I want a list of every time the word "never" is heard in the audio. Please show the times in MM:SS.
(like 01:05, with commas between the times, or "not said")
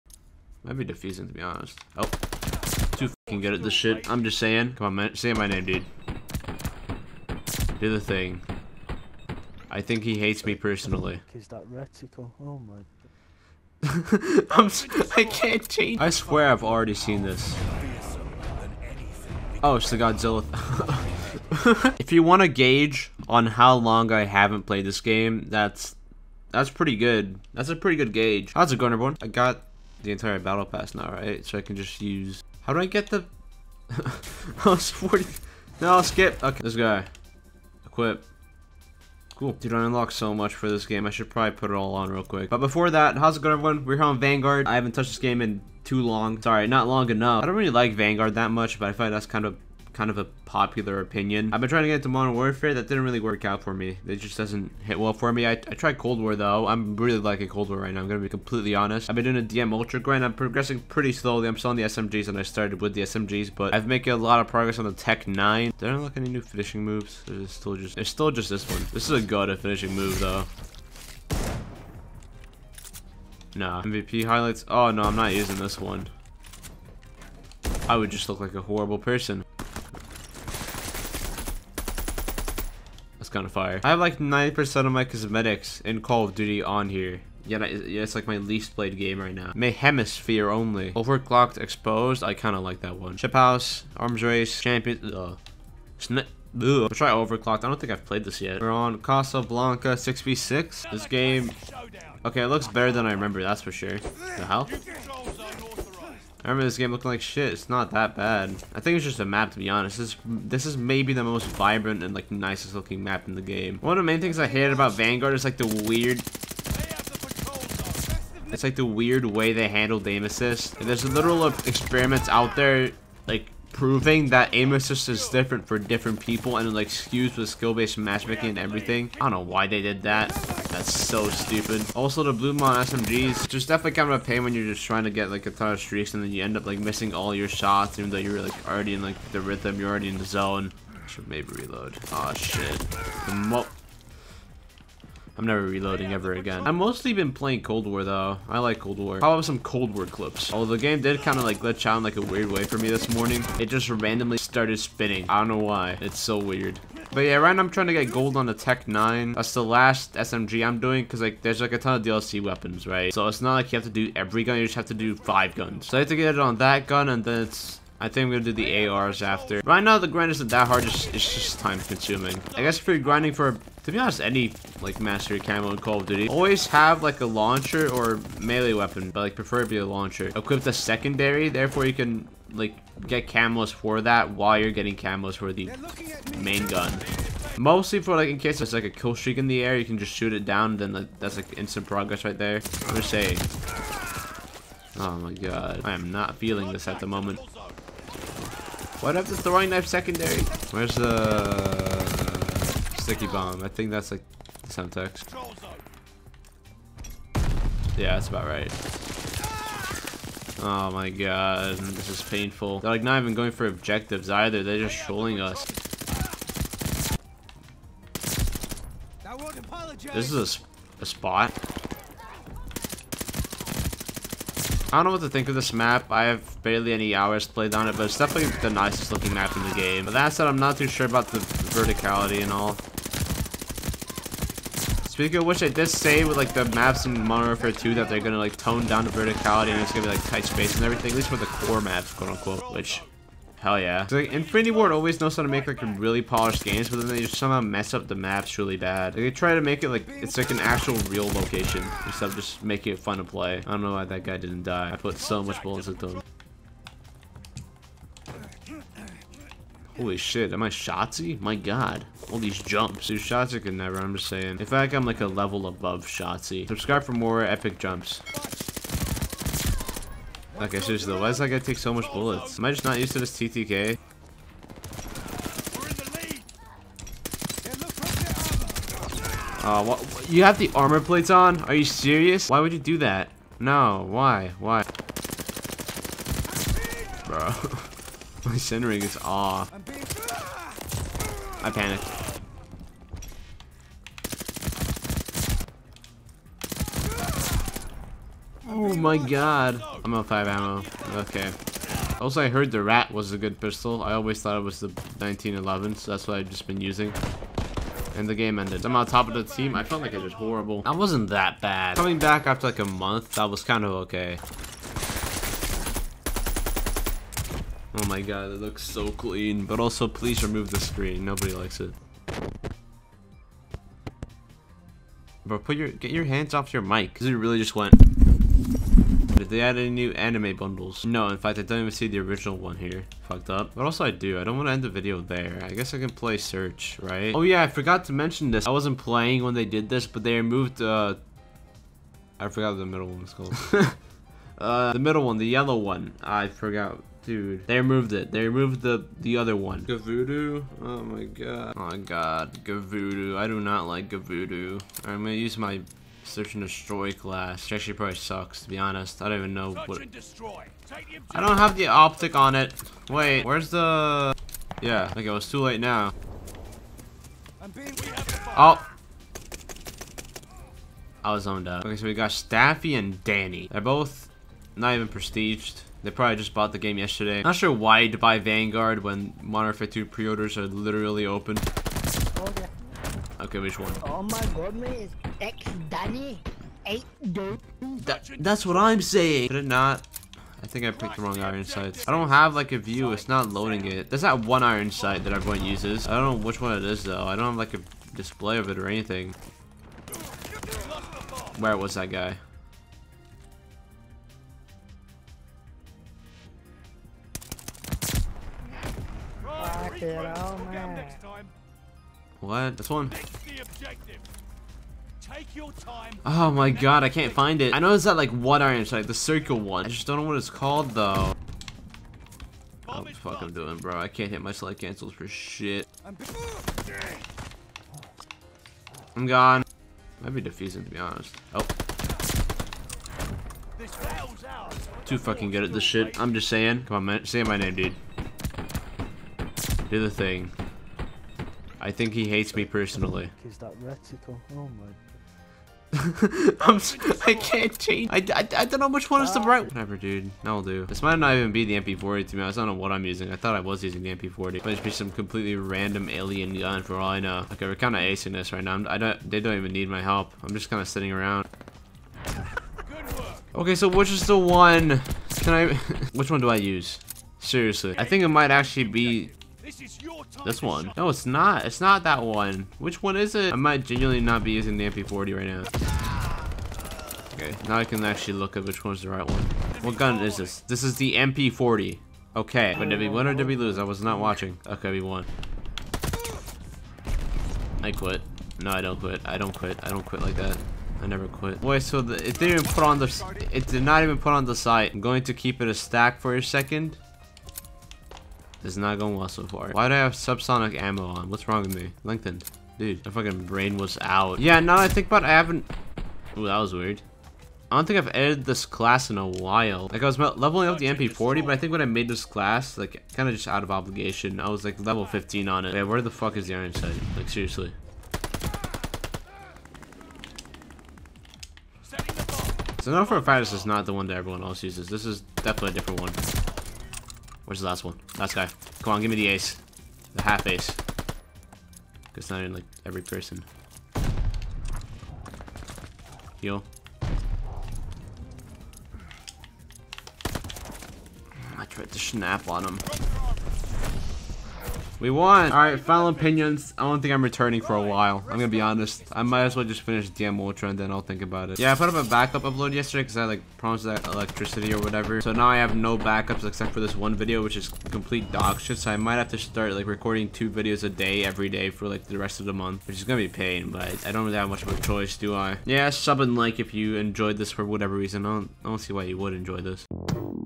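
02:25, 04:23, 08:11.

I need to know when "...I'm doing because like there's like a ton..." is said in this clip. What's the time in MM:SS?
02:40.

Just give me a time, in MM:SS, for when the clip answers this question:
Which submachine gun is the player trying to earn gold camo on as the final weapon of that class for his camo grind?
01:04.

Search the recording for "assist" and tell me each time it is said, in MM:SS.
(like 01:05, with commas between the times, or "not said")
02:00, 02:04.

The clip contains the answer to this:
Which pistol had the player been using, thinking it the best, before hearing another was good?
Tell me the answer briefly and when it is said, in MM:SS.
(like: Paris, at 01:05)
1911, at 05:04.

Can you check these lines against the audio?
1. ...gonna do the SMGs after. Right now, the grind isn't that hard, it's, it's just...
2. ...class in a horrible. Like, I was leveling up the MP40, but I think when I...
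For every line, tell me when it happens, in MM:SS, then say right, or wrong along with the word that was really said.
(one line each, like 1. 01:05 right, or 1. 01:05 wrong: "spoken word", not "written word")
1. 02:48 wrong: "ARs", not "SMGs"
2. 08:28 wrong: "while", not "horrible".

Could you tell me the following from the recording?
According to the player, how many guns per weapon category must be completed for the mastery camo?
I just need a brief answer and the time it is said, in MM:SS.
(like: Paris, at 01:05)
5, at 02:45.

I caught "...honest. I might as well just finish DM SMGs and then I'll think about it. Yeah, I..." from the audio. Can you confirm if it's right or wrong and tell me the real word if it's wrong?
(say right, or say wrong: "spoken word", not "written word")
wrong: "Ultra", not "SMGs".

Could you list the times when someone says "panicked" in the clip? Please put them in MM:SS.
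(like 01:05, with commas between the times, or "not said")
04:51.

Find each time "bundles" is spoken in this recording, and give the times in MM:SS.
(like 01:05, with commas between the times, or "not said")
05:30.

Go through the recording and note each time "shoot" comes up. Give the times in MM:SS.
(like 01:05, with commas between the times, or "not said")
03:10.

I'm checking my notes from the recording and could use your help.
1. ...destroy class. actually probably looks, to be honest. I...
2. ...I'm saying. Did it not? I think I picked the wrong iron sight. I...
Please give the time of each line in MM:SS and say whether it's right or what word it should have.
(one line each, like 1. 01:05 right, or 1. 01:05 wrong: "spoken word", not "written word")
1. 05:56 wrong: "sucks", not "looks"
2. 06:28 right.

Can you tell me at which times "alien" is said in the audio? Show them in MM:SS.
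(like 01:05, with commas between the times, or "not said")
07:36.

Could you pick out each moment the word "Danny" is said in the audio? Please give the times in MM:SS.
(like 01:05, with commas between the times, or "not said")
06:13, 06:25.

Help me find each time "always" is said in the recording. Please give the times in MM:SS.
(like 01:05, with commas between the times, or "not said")
02:56, 04:04, 05:04.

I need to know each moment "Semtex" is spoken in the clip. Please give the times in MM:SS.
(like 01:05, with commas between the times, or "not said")
03:24.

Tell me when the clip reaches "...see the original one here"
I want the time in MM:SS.
05:31.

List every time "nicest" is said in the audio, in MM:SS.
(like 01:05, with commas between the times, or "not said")
01:52, 03:48.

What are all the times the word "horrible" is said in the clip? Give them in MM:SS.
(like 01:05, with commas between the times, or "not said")
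01:18, 05:10.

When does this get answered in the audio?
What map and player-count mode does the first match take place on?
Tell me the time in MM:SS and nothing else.
01:39.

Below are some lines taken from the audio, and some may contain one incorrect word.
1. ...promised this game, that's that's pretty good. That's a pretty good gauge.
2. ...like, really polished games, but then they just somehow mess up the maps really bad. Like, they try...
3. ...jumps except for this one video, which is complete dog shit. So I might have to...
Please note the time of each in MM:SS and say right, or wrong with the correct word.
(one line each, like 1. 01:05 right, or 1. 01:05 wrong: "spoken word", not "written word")
1. 00:24 wrong: "played", not "promised"
2. 04:05 right
3. 09:15 wrong: "backups", not "jumps".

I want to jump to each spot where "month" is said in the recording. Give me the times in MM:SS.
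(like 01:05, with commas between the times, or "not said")
05:12, 09:22.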